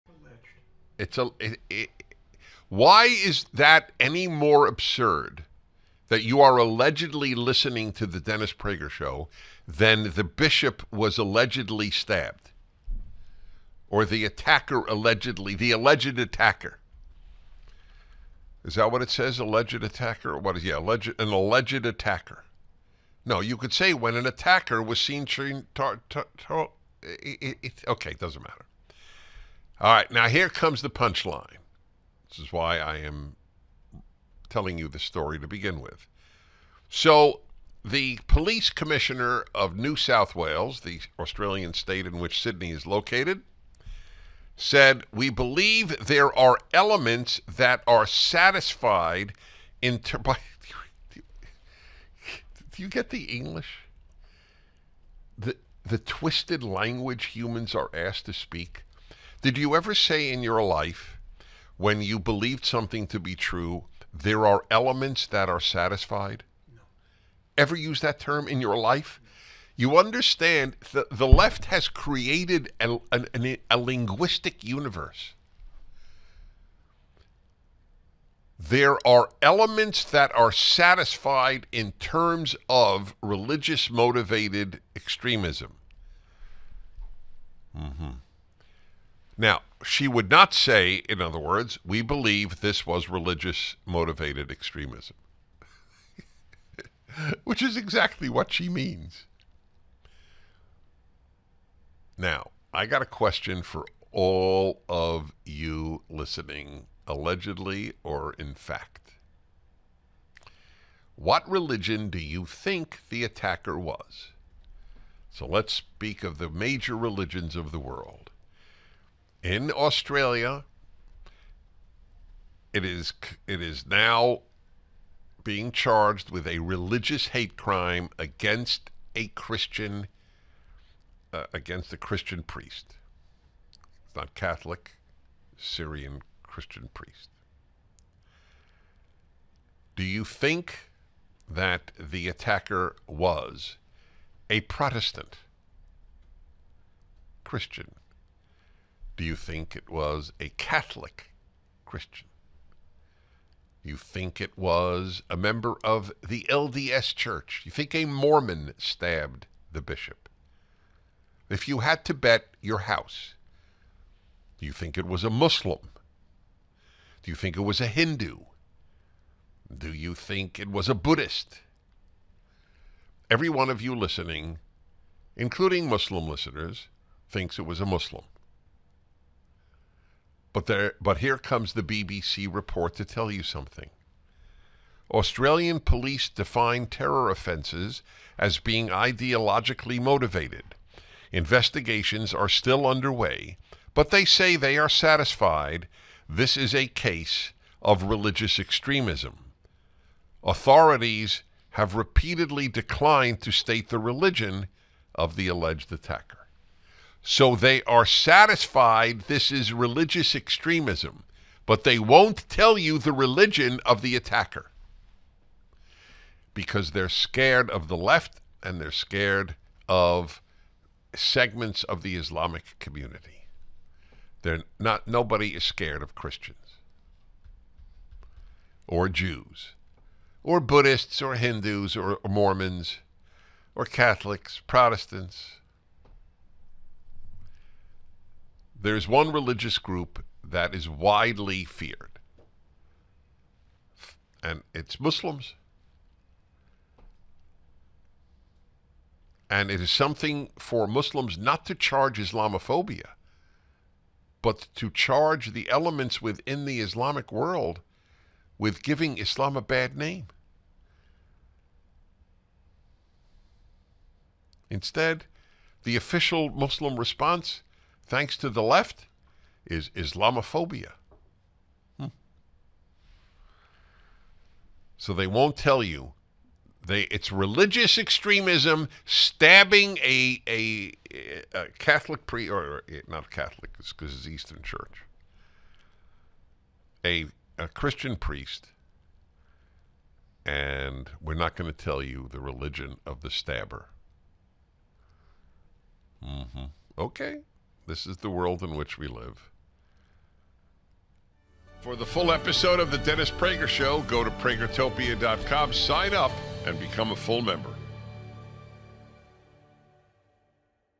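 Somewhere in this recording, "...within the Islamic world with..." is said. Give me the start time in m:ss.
4:16.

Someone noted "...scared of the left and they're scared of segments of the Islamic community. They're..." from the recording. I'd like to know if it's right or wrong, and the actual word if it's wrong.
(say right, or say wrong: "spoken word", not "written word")
right.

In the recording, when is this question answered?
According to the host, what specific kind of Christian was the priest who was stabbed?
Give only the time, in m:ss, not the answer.
2:15.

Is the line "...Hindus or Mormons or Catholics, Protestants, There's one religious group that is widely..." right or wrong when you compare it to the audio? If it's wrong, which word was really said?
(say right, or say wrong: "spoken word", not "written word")
right.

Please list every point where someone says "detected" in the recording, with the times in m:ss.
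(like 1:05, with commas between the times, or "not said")
not said.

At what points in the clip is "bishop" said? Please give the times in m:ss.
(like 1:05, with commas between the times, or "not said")
0:10, 2:39.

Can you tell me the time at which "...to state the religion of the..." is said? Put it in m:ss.
3:23.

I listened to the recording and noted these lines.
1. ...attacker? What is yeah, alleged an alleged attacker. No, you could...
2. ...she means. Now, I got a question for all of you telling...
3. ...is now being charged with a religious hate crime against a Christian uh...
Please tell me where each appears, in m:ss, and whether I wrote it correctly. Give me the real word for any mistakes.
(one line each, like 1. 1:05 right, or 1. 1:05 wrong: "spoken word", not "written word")
1. 0:19 right
2. 1:38 wrong: "listening", not "telling"
3. 2:03 right.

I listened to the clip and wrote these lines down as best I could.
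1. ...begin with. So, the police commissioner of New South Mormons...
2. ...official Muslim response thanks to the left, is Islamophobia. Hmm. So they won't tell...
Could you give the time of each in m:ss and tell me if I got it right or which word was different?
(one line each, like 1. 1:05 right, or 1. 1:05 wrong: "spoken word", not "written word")
1. 0:35 wrong: "Wales", not "Mormons"
2. 4:25 right.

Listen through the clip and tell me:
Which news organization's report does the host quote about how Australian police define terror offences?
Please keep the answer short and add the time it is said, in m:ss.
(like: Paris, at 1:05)
BBC, at 3:01.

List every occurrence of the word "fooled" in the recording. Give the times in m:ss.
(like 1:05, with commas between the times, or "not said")
not said.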